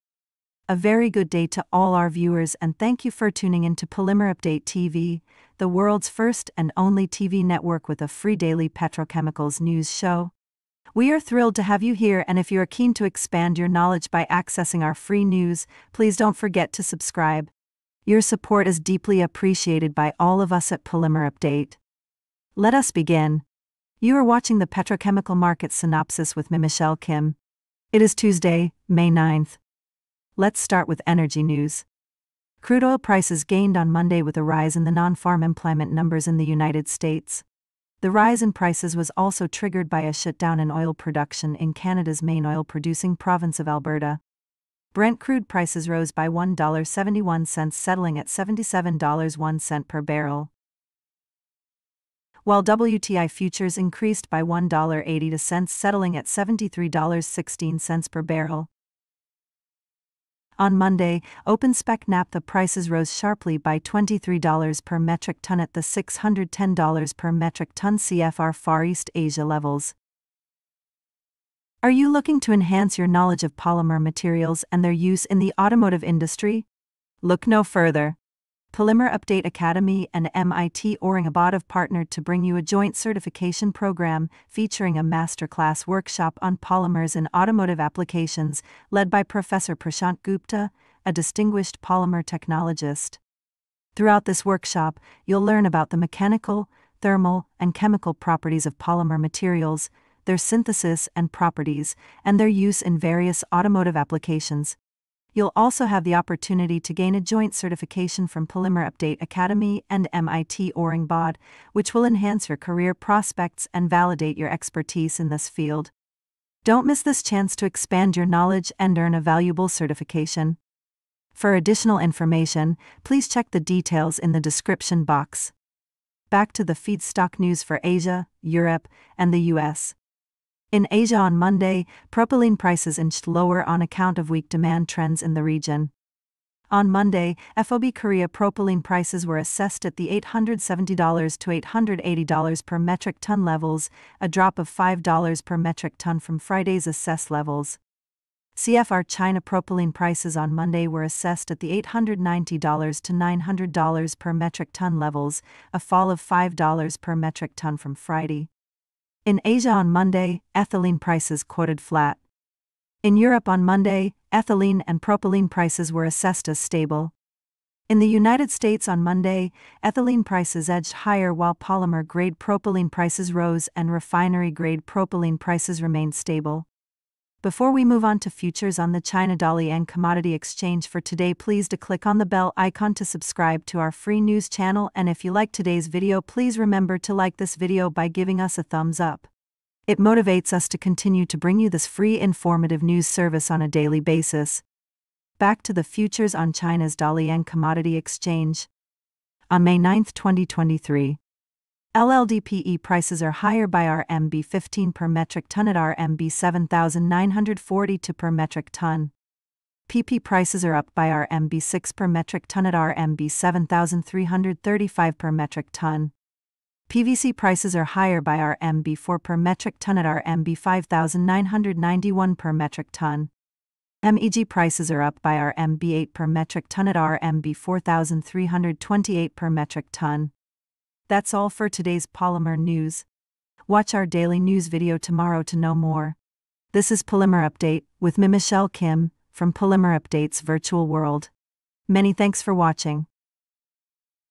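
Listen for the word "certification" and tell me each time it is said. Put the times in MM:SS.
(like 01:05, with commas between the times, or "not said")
01:22, 01:47, 01:59.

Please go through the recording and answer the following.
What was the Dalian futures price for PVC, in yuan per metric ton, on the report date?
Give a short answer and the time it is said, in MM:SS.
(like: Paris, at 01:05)
RMB 5,991, at 03:40.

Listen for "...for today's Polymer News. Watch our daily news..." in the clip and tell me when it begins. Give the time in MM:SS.
03:51.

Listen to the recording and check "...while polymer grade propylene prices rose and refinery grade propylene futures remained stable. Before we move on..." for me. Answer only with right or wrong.
wrong.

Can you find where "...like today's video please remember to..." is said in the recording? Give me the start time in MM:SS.
03:05.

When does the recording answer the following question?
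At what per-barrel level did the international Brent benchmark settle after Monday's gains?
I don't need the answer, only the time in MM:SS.
00:48.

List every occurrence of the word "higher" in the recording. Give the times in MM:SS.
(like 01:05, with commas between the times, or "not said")
02:51, 03:23, 03:37.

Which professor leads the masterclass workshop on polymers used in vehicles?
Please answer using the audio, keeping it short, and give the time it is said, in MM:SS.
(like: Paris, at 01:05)
Prashant Gupta, at 01:29.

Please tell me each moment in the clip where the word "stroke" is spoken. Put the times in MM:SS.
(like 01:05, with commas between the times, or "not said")
not said.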